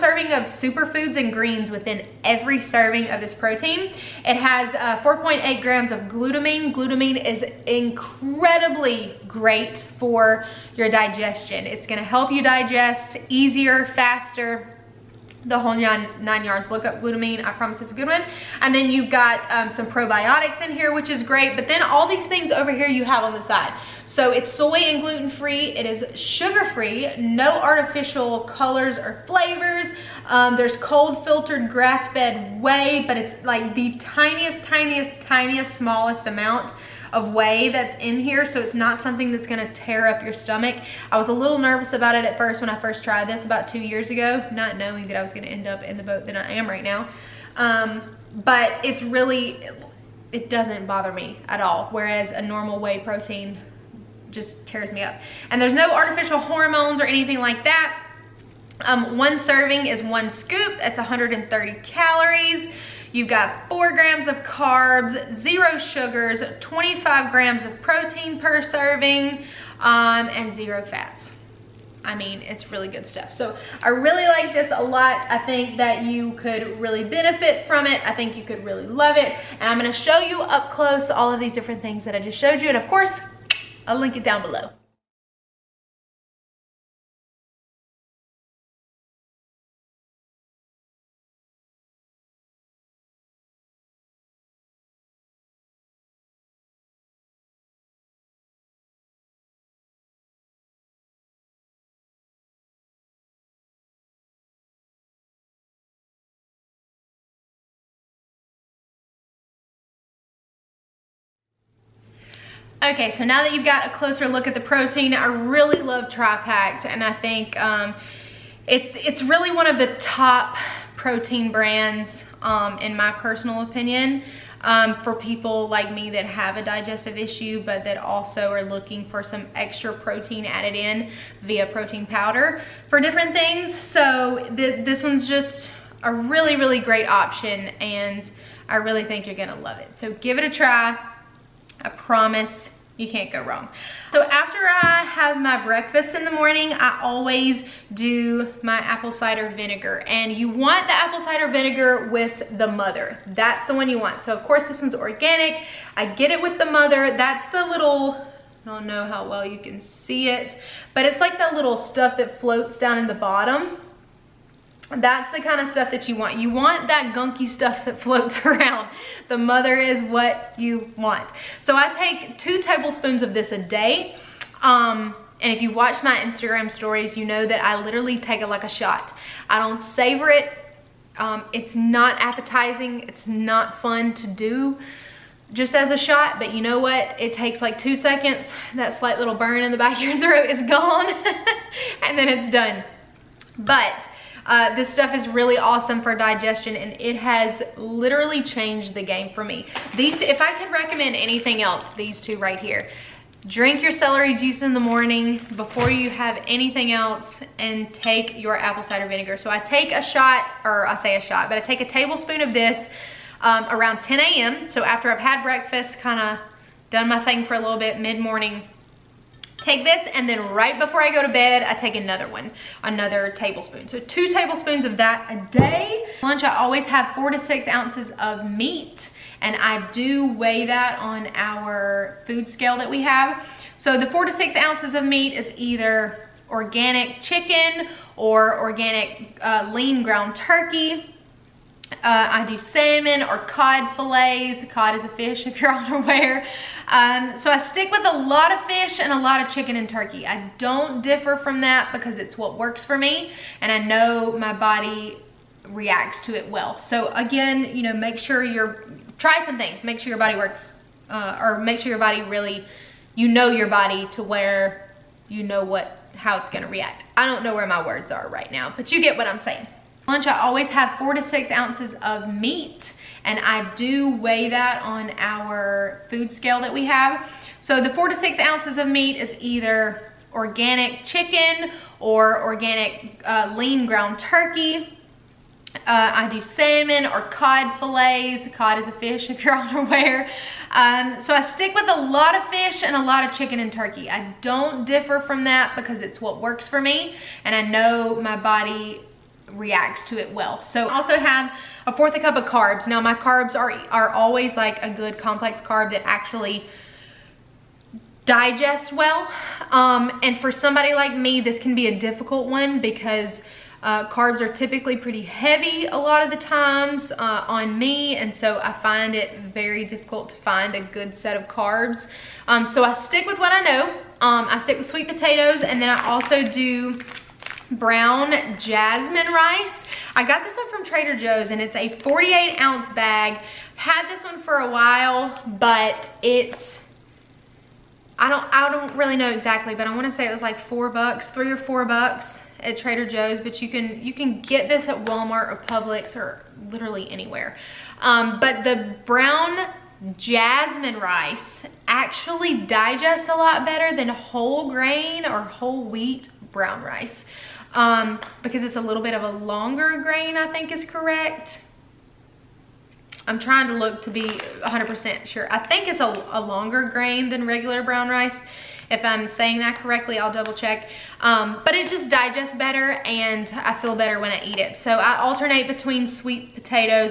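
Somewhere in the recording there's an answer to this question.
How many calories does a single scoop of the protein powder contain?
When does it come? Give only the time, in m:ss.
1:00.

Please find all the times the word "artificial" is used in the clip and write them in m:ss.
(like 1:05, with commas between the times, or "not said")
0:27, 0:55.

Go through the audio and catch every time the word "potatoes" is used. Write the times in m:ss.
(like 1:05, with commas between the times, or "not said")
5:25, 6:16.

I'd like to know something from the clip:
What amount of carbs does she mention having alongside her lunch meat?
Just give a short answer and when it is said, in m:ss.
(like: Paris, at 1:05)
1/4 cup, at 5:01.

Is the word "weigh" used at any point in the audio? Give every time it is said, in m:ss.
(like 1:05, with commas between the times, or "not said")
3:50, 4:34.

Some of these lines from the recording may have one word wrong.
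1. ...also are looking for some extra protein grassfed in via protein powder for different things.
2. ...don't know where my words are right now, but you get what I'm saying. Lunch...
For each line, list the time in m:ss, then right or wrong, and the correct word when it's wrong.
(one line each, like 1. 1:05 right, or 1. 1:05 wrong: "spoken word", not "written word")
1. 2:07 wrong: "added", not "grassfed"
2. 4:27 right.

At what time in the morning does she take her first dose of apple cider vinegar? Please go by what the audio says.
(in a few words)
10 a.m.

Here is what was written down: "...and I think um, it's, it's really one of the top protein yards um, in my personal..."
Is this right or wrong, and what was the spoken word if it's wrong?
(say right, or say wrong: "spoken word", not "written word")
wrong: "brands", not "yards".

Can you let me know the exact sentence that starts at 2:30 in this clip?
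And you want the apple cider vinegar with the mother.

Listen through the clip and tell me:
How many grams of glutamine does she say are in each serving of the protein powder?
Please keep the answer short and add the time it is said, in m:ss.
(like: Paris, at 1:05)
4.8 grams, at 0:05.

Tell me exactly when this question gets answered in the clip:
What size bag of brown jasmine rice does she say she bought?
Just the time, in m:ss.
5:31.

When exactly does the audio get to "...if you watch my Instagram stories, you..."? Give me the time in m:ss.
2:55.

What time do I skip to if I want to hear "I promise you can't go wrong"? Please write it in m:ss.
2:21.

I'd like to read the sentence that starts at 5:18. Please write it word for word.
And so I find it very difficult to find a good set of carbs.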